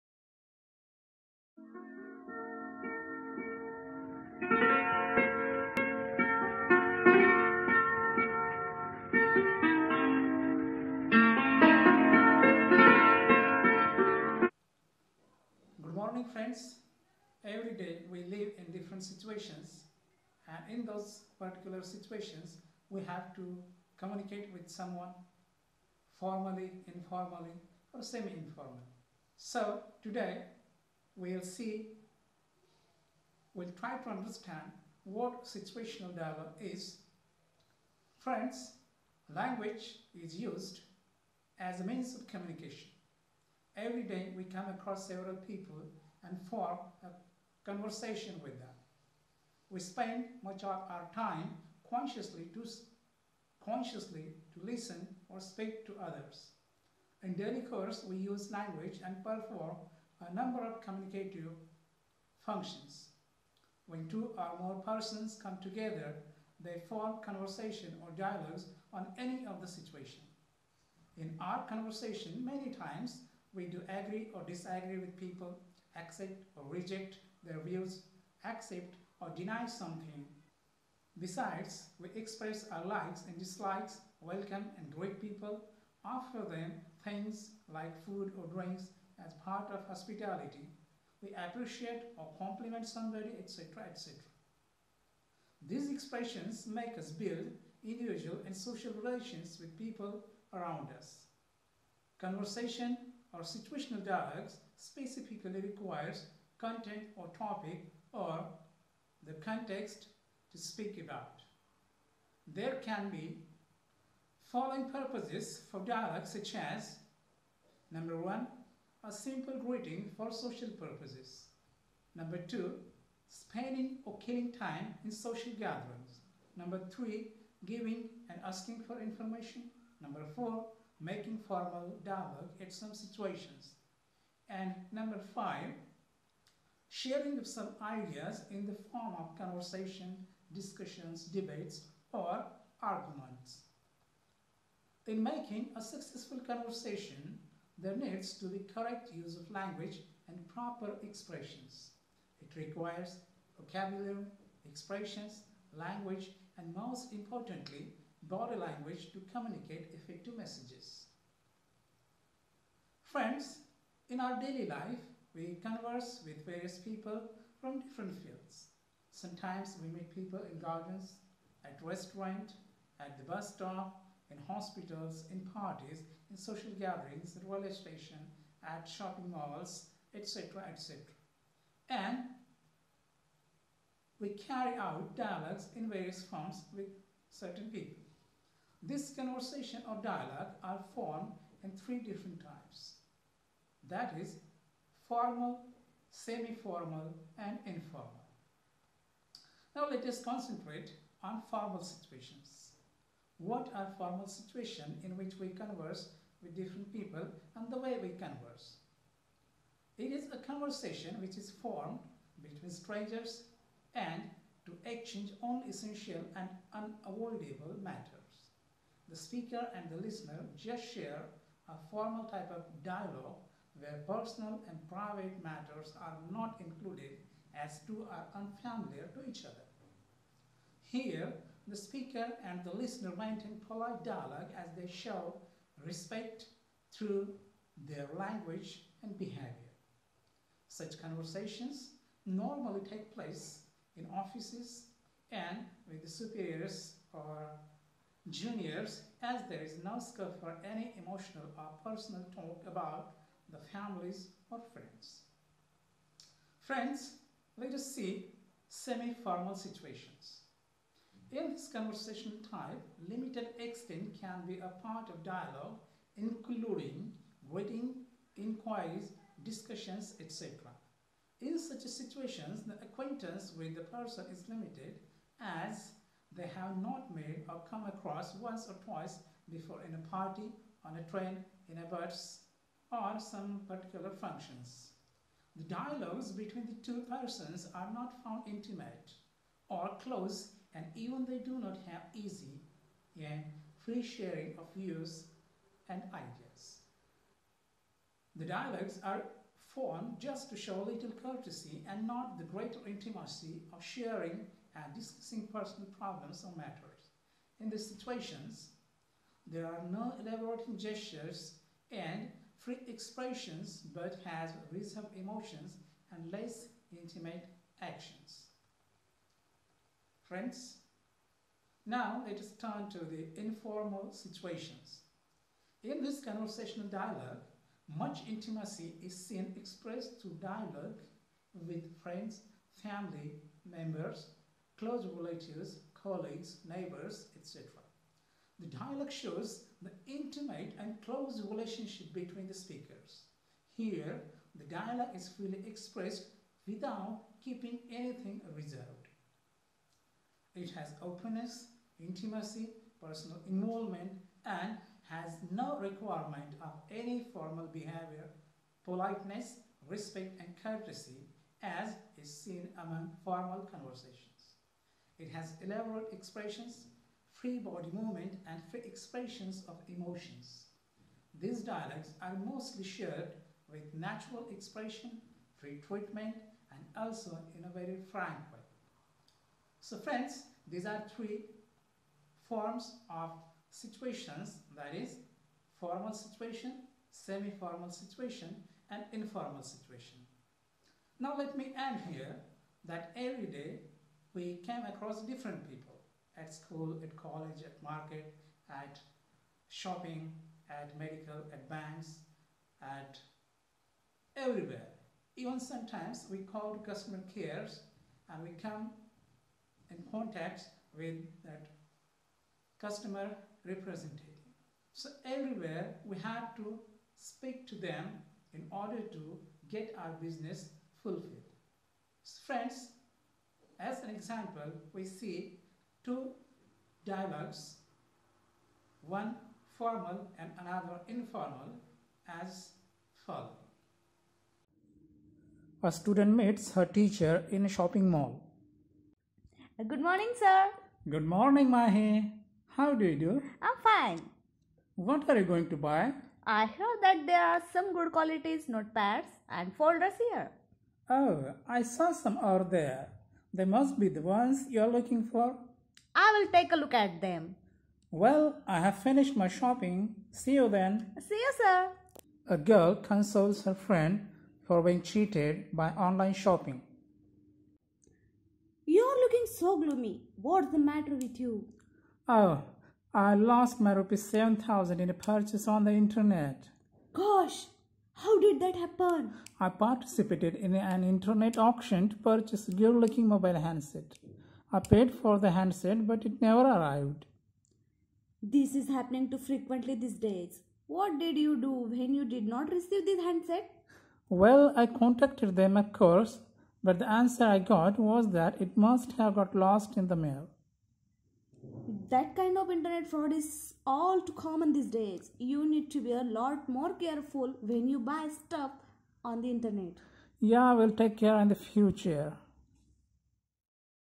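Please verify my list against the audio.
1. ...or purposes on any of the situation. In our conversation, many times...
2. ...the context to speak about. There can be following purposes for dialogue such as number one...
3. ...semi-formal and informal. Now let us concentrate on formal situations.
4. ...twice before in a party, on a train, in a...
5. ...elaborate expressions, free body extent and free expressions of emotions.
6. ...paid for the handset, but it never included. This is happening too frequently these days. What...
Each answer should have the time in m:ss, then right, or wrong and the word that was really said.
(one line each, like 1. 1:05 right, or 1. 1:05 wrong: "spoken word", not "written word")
1. 1:08 wrong: "dialogues", not "purposes"
2. 1:49 right
3. 3:16 right
4. 4:38 right
5. 6:05 wrong: "movement", not "extent"
6. 8:04 wrong: "arrived", not "included".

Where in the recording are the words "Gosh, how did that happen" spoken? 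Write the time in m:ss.
7:57.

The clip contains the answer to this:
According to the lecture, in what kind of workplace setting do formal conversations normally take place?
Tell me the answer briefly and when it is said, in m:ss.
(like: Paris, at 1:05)
Offices, at 4:04.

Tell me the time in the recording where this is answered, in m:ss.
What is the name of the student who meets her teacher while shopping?
7:21.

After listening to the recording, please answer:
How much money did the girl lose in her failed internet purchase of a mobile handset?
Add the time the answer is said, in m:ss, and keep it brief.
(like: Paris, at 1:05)
Rs 7000, at 7:53.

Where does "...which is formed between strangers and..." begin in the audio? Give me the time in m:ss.
3:31.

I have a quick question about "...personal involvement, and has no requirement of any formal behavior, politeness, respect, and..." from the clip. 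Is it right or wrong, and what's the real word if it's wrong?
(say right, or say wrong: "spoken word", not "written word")
right.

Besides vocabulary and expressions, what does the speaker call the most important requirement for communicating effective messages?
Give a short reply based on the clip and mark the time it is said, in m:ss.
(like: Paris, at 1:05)
Body language, at 2:38.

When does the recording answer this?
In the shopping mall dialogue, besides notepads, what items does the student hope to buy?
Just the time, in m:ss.
7:29.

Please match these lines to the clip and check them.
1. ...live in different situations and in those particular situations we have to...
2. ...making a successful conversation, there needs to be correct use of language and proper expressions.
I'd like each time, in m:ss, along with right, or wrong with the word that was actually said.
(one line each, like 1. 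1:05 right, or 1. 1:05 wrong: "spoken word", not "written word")
1. 0:18 right
2. 2:25 right.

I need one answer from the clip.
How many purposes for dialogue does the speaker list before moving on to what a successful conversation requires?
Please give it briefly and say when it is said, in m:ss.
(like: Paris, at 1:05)
5, at 2:15.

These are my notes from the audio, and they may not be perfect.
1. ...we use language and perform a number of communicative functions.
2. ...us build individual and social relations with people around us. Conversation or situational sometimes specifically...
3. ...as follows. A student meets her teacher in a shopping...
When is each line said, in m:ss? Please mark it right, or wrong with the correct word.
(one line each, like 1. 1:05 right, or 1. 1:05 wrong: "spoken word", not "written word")
1. 0:58 right
2. 1:36 wrong: "dialogues", not "sometimes"
3. 7:12 right.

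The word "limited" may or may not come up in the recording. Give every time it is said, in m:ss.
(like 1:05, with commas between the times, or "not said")
4:23, 4:34.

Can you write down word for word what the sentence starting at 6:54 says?
So everywhere we had to speak to them in order to get our business fulfilled.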